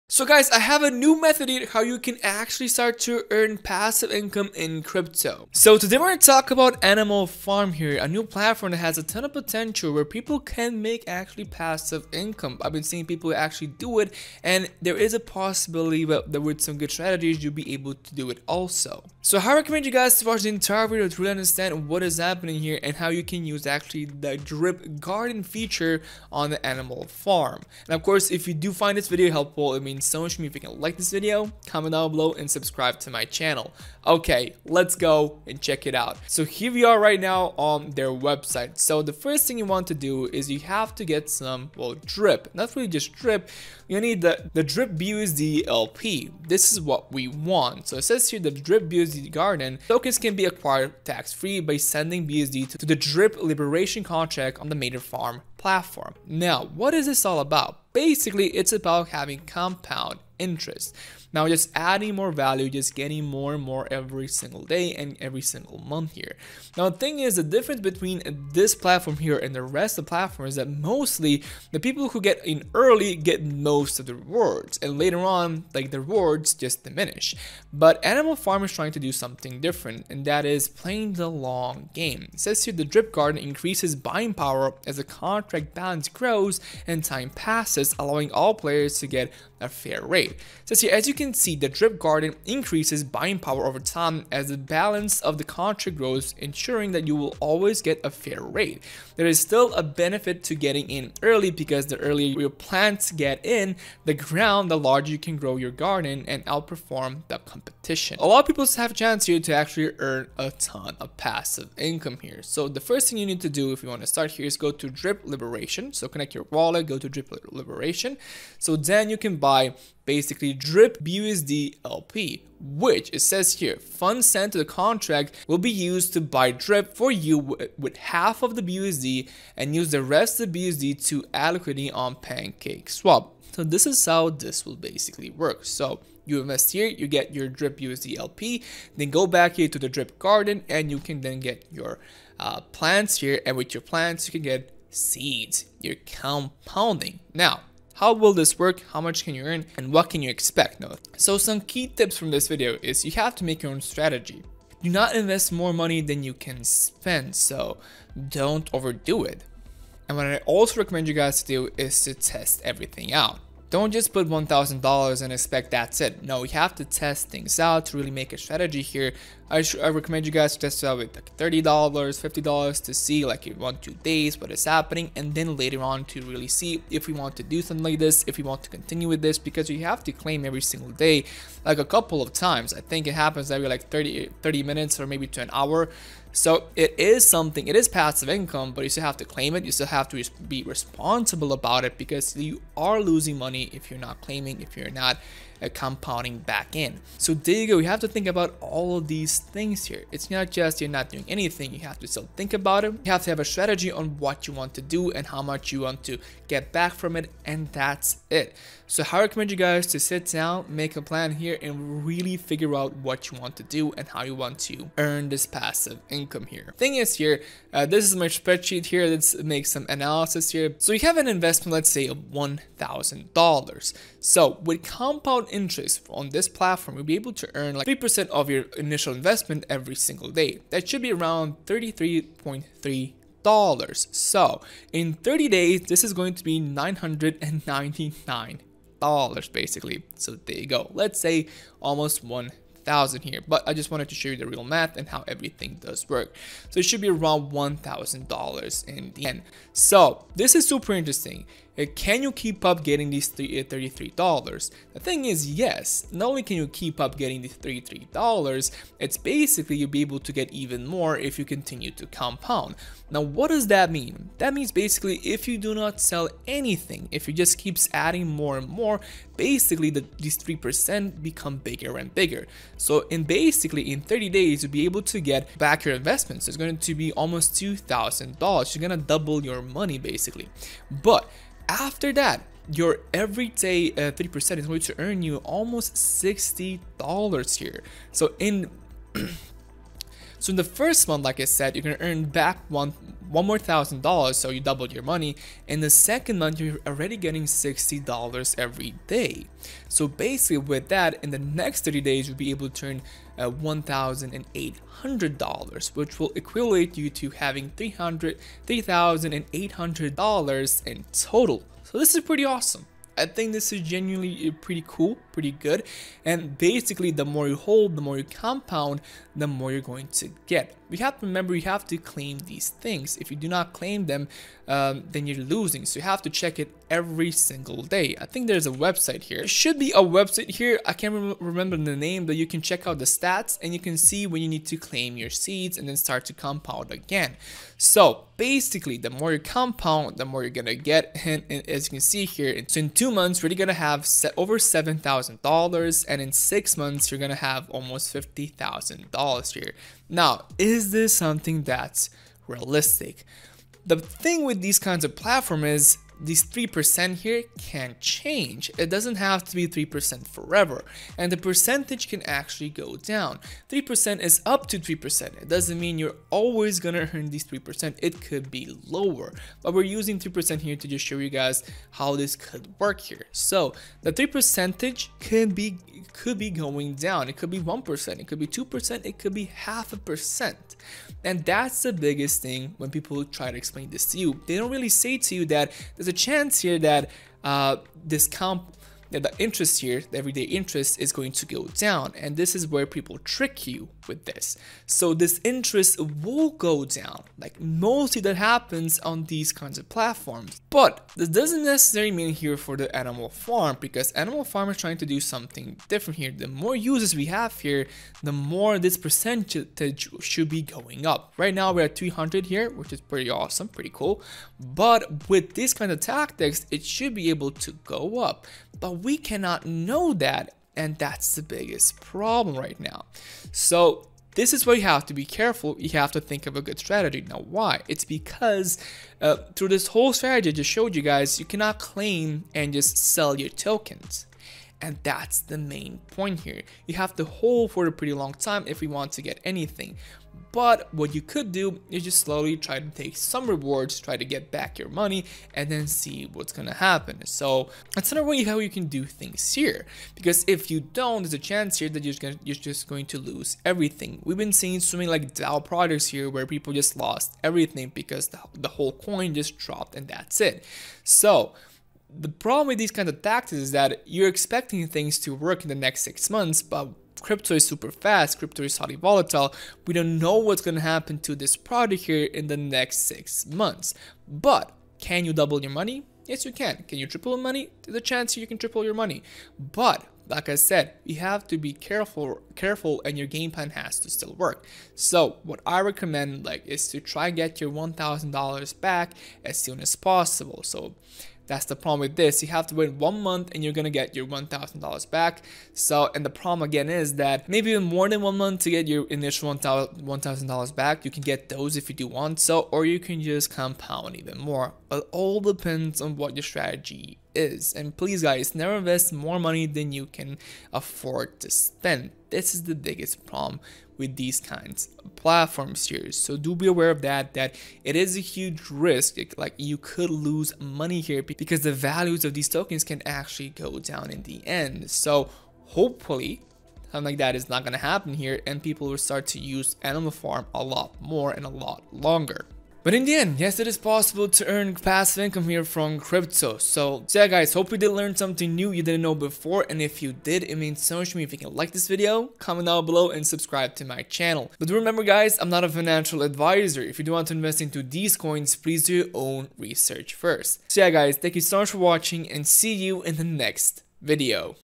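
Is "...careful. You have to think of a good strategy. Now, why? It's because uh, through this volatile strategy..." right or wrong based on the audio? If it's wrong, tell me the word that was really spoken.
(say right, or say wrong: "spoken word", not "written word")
wrong: "whole", not "volatile".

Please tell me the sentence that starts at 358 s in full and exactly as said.
It doesn't have to be 3% forever, and the percentage can actually go down.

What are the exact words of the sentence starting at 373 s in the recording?
So the 3 percentage could be could be going down.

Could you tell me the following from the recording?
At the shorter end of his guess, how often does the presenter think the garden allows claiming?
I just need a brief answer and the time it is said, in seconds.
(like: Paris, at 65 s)
30 minutes, at 183 s.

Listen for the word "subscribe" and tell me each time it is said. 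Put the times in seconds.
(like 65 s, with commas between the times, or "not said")
32 s, 543 s.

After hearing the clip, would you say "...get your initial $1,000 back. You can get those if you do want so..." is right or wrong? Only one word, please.
right.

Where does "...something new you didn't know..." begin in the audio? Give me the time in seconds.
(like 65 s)
538 s.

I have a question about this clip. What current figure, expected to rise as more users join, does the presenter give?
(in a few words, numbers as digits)
300.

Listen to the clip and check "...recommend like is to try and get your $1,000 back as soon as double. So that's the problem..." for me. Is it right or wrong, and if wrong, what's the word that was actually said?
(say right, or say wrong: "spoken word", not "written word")
wrong: "possible", not "double".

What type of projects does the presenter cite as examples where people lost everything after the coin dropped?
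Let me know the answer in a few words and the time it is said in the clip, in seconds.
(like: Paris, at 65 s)
DAO projects, at 455 s.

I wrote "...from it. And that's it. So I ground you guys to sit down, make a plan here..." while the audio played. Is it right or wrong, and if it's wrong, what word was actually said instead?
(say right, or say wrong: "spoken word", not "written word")
wrong: "recommend", not "ground".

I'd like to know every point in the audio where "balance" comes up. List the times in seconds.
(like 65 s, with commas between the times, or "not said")
85 s, 94 s.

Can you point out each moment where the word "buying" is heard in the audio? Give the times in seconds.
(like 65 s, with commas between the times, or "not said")
83 s, 93 s.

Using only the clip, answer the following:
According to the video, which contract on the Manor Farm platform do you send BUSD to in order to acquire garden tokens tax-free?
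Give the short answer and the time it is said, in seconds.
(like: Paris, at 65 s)
Drip liberation contract, at 52 s.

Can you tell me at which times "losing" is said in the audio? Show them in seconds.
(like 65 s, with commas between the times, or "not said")
193 s, 325 s.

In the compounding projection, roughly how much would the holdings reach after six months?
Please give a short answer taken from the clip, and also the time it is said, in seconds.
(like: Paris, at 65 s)
almost $50,000, at 347 s.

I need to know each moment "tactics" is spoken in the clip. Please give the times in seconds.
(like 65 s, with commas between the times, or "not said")
416 s, 463 s.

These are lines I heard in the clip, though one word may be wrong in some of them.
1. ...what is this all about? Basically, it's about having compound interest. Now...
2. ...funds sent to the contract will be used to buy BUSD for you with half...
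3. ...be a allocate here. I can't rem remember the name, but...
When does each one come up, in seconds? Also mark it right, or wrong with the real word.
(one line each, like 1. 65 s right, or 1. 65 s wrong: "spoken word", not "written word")
1. 56 s right
2. 123 s wrong: "DRIP", not "BUSD"
3. 329 s wrong: "website", not "allocate".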